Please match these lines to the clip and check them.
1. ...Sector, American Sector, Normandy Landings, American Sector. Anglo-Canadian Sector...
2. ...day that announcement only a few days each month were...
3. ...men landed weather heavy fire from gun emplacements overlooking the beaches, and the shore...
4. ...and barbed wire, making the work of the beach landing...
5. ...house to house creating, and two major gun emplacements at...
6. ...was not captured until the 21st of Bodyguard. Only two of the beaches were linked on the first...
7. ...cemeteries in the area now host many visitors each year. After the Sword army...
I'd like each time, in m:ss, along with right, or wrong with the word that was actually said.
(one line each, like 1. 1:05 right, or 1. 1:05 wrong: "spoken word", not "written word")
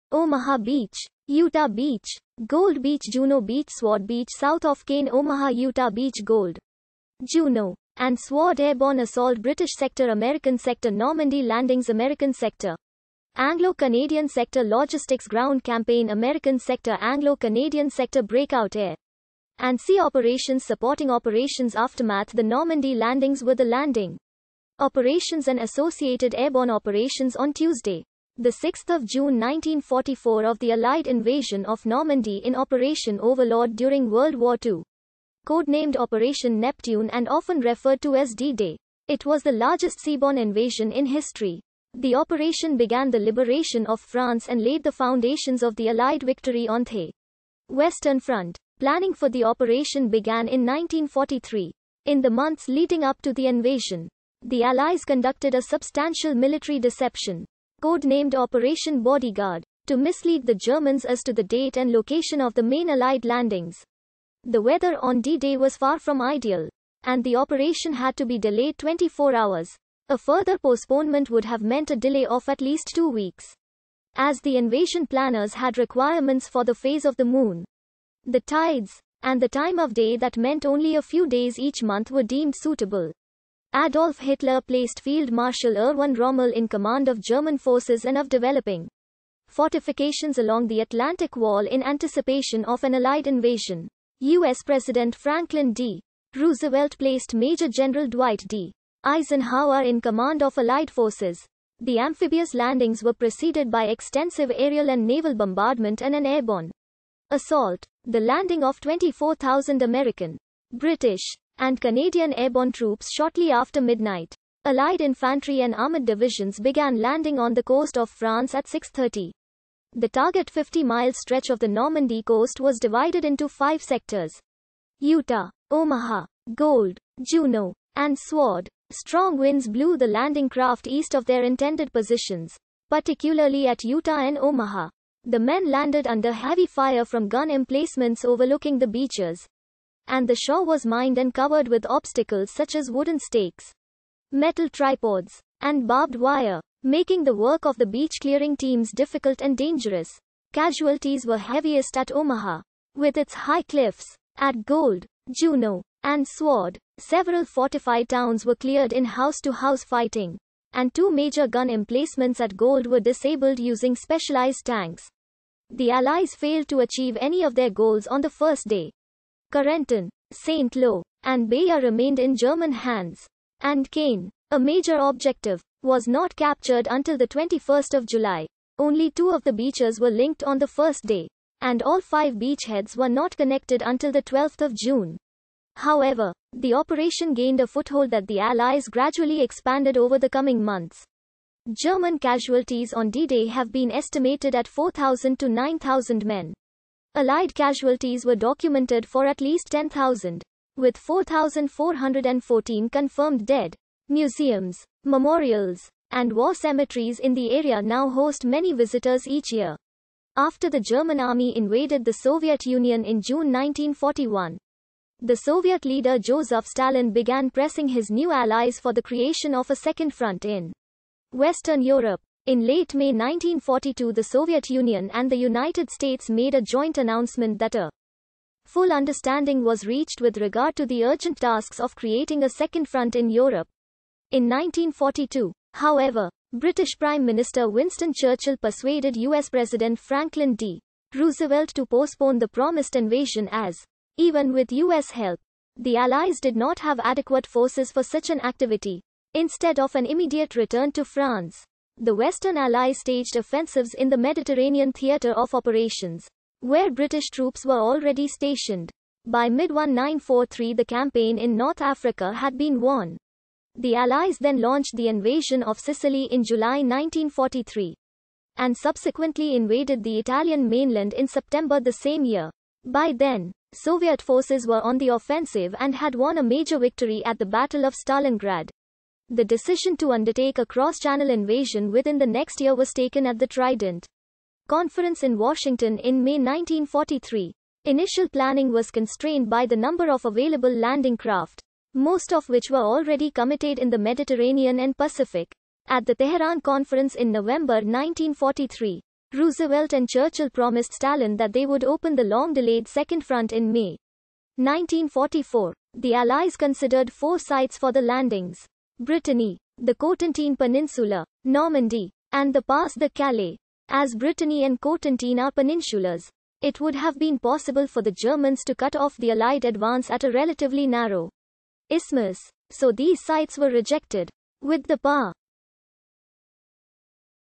1. 0:09 right
2. 1:19 wrong: "meant", not "announcement"
3. 2:15 wrong: "under", not "weather"
4. 2:25 wrong: "clearing", not "landing"
5. 2:39 wrong: "fighting", not "creating"
6. 2:55 wrong: "July", not "Bodyguard"
7. 3:26 wrong: "German", not "Sword".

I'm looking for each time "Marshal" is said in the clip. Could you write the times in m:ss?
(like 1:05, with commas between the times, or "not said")
1:25.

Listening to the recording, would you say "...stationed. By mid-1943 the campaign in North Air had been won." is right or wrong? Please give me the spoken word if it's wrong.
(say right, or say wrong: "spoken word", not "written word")
wrong: "Africa", not "Air".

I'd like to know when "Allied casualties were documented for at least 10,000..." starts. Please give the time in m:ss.
3:17.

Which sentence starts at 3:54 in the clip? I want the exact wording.
In 1942, however, British Prime Minister Winston Churchill persuaded US President Franklin D.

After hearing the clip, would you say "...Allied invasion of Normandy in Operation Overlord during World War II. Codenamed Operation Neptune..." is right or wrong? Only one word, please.
right.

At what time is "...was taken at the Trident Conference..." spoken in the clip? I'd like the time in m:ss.
4:42.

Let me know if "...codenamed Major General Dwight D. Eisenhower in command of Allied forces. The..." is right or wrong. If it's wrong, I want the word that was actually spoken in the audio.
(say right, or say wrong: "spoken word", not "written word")
wrong: "placed", not "codenamed".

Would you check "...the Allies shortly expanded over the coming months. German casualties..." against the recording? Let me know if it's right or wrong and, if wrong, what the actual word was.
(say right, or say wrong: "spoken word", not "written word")
wrong: "gradually", not "shortly".